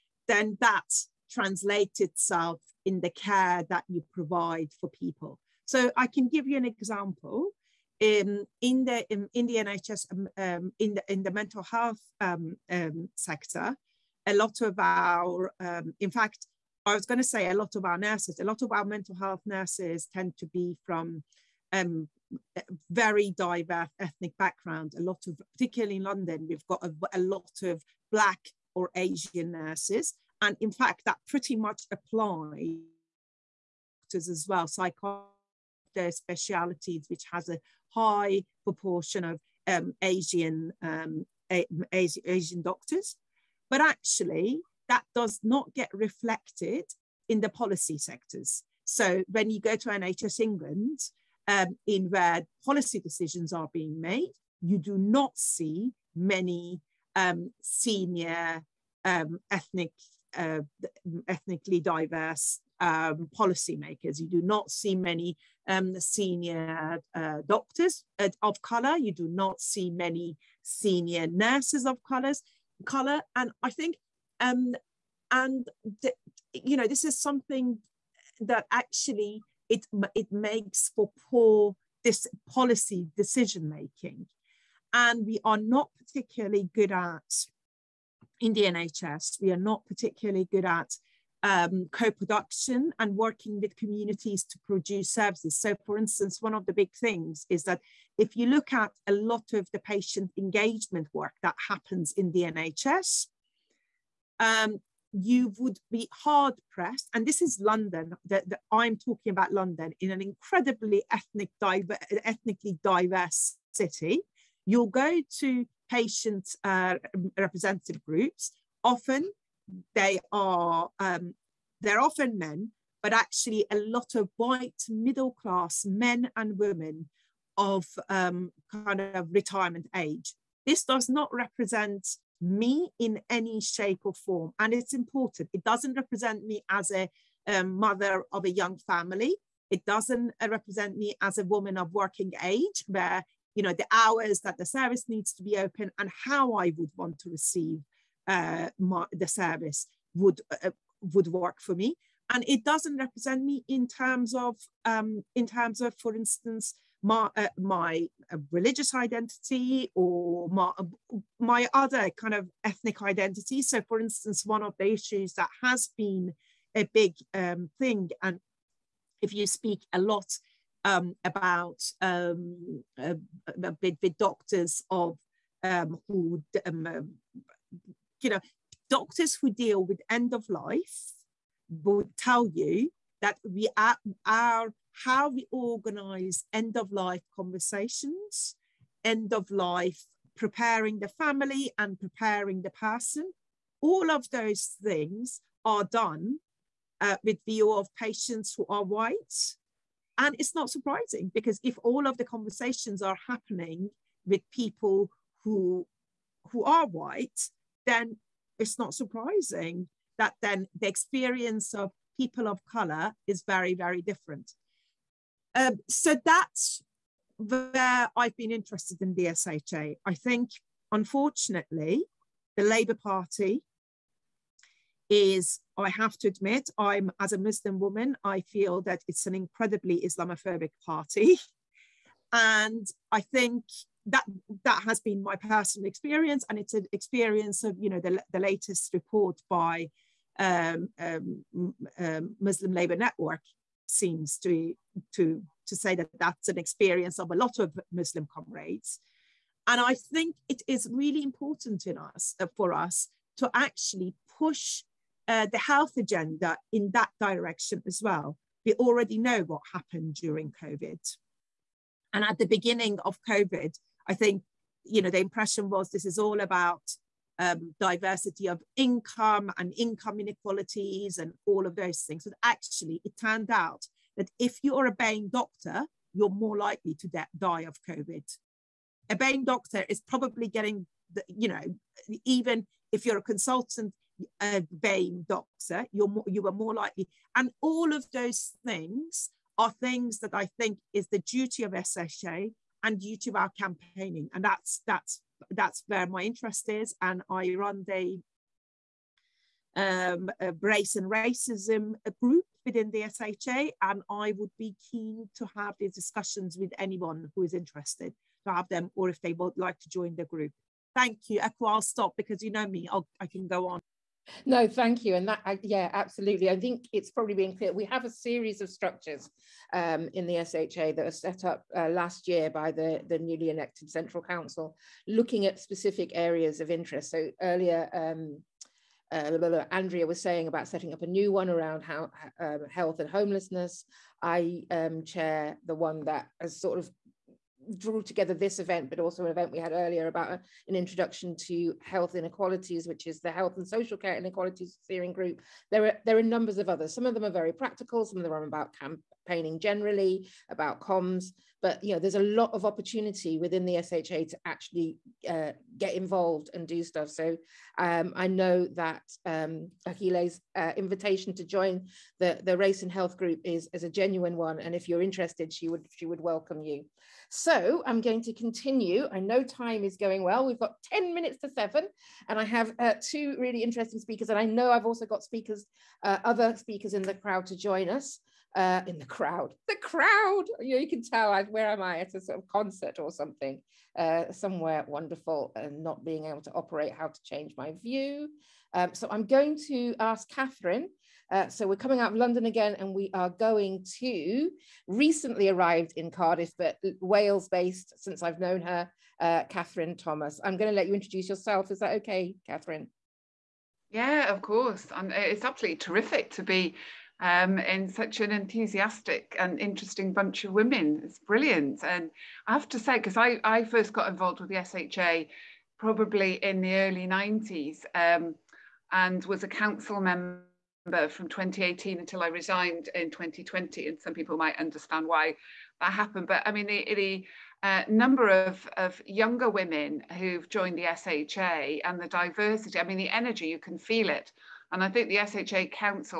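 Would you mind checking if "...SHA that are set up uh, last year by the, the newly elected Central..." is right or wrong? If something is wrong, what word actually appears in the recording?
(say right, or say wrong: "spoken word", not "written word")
right.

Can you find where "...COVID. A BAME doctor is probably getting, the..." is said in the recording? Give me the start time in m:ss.
4:37.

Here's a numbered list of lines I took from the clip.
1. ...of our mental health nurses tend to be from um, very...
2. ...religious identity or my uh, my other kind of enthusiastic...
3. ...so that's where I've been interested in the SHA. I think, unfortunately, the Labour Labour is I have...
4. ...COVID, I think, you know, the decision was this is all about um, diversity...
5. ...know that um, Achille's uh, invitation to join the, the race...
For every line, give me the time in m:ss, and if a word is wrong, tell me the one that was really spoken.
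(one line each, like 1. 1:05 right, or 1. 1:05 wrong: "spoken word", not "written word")
1. 0:18 right
2. 2:38 wrong: "ethnic", not "enthusiastic"
3. 3:35 wrong: "Party", not "Labour"
4. 4:23 wrong: "impression", not "decision"
5. 5:58 right.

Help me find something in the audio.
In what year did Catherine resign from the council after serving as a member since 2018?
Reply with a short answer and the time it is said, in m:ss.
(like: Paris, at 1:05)
2020, at 7:03.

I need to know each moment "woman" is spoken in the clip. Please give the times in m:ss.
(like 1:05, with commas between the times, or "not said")
2:21, 3:47.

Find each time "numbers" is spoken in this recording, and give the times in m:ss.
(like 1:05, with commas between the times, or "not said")
5:46, 7:07.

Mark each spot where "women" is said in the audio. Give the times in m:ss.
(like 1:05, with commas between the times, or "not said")
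2:06, 6:50, 7:09.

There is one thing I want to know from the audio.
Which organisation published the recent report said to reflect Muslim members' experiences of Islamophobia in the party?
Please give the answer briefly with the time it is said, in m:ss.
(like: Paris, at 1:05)
Muslim Labour Network, at 4:02.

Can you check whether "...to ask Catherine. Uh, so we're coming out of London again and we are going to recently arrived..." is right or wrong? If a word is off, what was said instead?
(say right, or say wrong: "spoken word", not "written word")
right.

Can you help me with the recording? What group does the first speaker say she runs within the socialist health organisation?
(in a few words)
race and racism group.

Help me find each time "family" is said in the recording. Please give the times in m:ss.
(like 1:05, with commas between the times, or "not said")
2:18, 3:11.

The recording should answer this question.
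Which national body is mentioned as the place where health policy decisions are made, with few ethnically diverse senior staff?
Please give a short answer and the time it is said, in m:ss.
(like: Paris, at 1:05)
NHS England, at 0:49.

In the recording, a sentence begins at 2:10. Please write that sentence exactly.
This does not represent me in any shape or form, and it's important.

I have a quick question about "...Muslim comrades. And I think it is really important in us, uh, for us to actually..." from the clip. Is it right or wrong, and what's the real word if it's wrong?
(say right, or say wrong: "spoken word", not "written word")
right.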